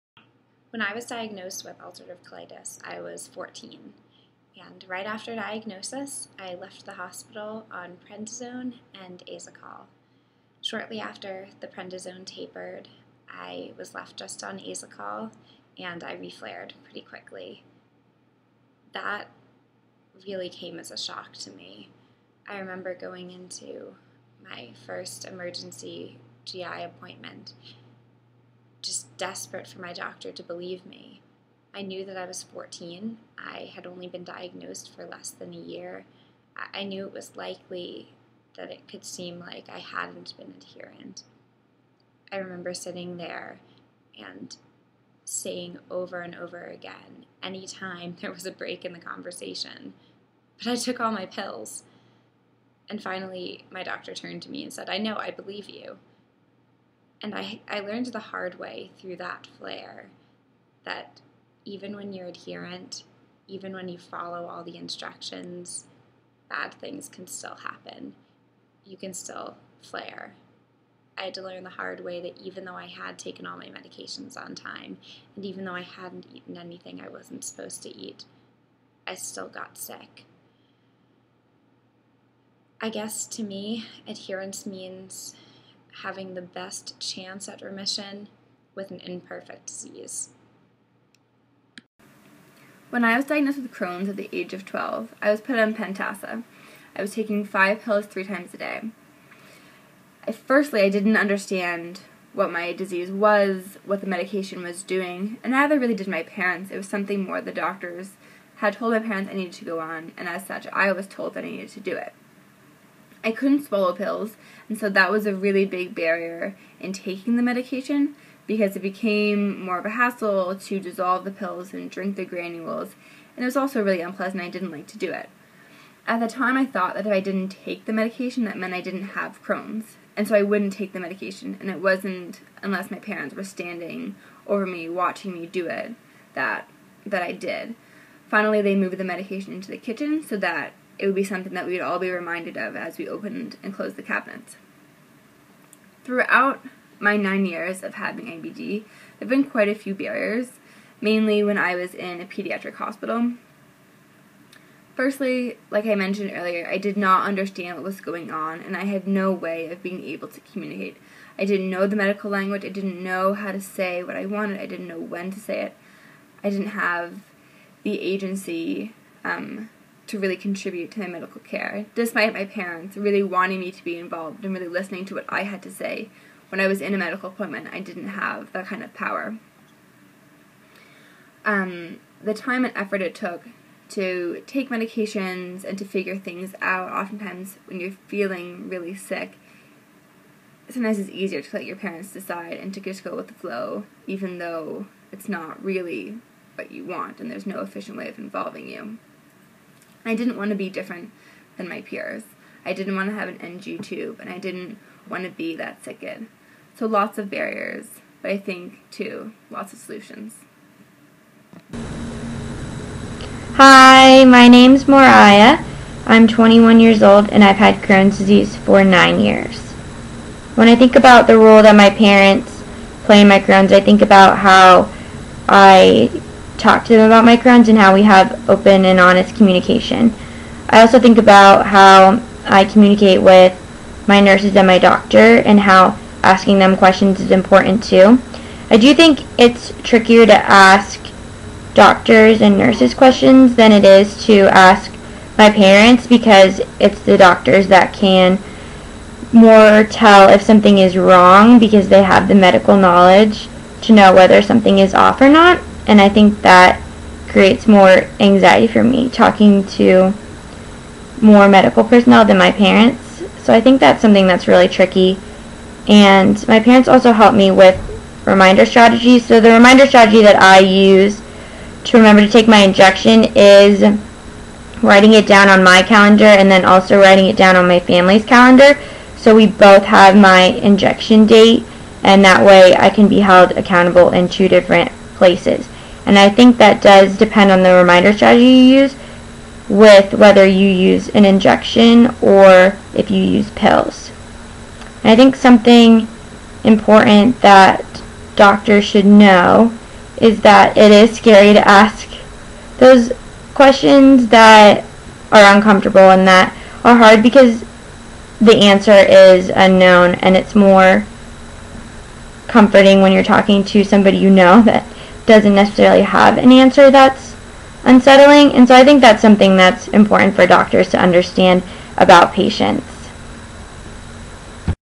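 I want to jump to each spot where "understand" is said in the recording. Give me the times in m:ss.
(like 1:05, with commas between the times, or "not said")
1:41, 2:37, 5:20.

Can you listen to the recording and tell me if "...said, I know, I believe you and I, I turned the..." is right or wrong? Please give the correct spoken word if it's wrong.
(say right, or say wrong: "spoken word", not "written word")
wrong: "learned", not "turned".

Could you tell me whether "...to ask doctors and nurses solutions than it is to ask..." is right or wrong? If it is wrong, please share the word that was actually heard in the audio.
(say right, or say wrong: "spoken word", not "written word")
wrong: "questions", not "solutions".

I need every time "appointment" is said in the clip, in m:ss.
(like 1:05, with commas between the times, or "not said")
0:26, 2:57.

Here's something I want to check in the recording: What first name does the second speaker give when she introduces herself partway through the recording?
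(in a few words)
Moriah.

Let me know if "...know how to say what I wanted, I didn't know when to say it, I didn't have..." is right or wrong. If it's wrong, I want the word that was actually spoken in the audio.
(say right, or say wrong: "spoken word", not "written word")
right.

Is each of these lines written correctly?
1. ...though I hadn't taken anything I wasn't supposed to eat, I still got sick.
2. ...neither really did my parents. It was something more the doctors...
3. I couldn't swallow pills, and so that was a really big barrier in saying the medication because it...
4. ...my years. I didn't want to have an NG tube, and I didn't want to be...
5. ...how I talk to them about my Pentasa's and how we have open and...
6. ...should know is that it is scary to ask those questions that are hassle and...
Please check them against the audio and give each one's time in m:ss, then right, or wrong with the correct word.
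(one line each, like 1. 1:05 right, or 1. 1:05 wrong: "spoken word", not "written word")
1. 1:15 wrong: "eaten", not "taken"
2. 1:45 right
3. 1:53 wrong: "taking", not "saying"
4. 3:21 wrong: "peers", not "years"
5. 3:44 wrong: "Crohn", not "Pentasa"
6. 4:58 wrong: "uncomfortable", not "hassle".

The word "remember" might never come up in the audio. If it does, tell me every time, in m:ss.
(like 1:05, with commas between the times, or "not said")
0:22, 0:42, 4:31.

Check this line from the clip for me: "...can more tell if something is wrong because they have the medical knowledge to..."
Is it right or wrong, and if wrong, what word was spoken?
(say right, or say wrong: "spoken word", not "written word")
right.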